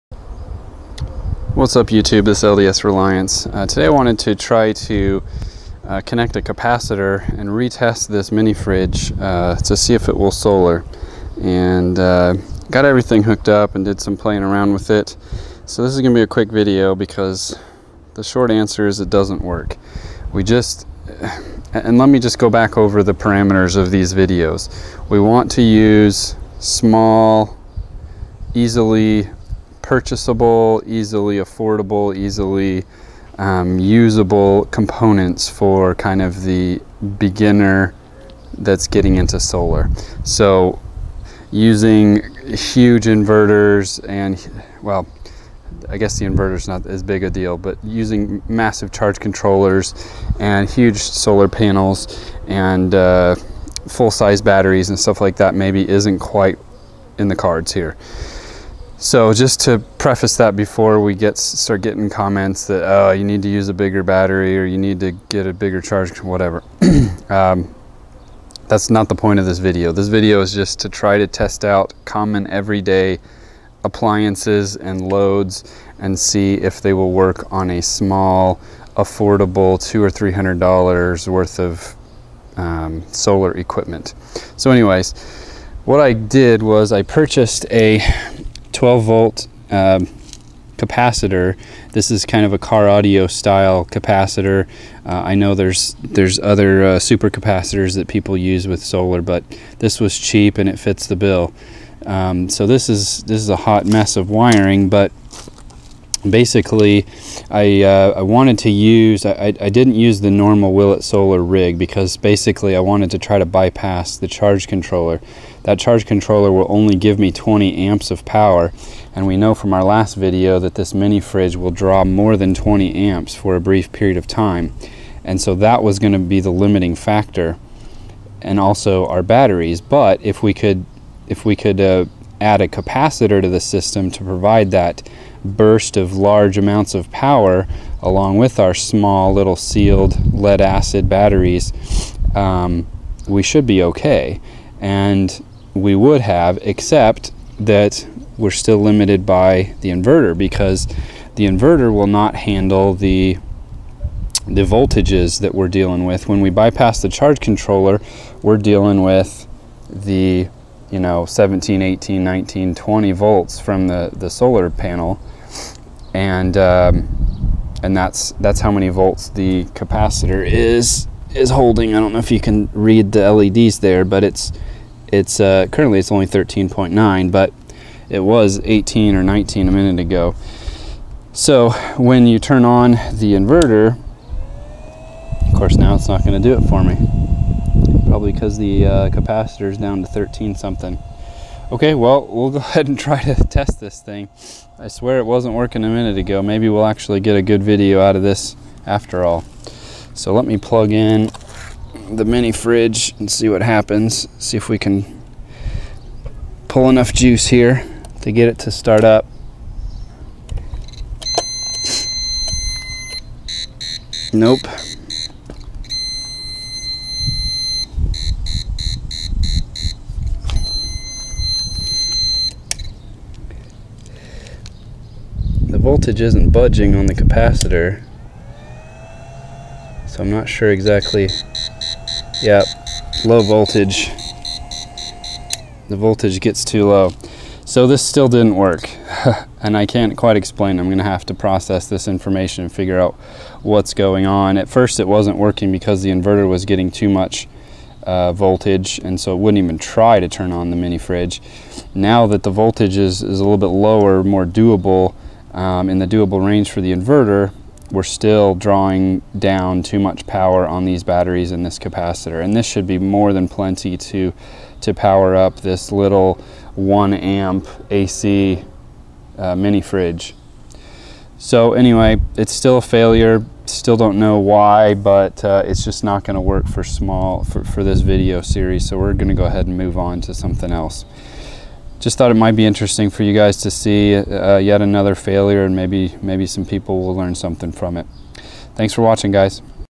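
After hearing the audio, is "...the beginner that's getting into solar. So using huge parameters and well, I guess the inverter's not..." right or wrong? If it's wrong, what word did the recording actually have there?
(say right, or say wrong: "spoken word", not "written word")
wrong: "inverters", not "parameters".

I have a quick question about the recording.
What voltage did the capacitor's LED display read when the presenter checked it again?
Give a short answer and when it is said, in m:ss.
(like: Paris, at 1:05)
13.9, at 2:56.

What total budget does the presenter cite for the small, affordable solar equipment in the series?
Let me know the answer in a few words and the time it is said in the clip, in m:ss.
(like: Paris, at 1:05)
200 or 300 dollars, at 1:19.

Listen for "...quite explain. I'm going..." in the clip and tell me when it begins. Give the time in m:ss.
4:00.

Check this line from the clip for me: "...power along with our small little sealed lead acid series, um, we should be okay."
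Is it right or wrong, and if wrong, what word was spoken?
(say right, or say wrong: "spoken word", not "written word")
wrong: "batteries", not "series".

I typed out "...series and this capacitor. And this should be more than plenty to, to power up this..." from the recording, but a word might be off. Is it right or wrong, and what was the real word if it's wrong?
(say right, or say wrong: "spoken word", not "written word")
wrong: "batteries", not "series".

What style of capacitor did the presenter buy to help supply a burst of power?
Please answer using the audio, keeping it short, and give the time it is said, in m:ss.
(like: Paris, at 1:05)
car audio style, at 1:32.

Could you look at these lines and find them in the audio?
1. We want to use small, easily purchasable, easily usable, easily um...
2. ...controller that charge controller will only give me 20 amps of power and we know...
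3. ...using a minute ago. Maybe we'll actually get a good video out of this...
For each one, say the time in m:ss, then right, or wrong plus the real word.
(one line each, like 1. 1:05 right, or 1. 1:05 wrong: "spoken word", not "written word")
1. 0:25 wrong: "affordable", not "usable"
2. 1:54 right
3. 3:15 wrong: "working", not "using".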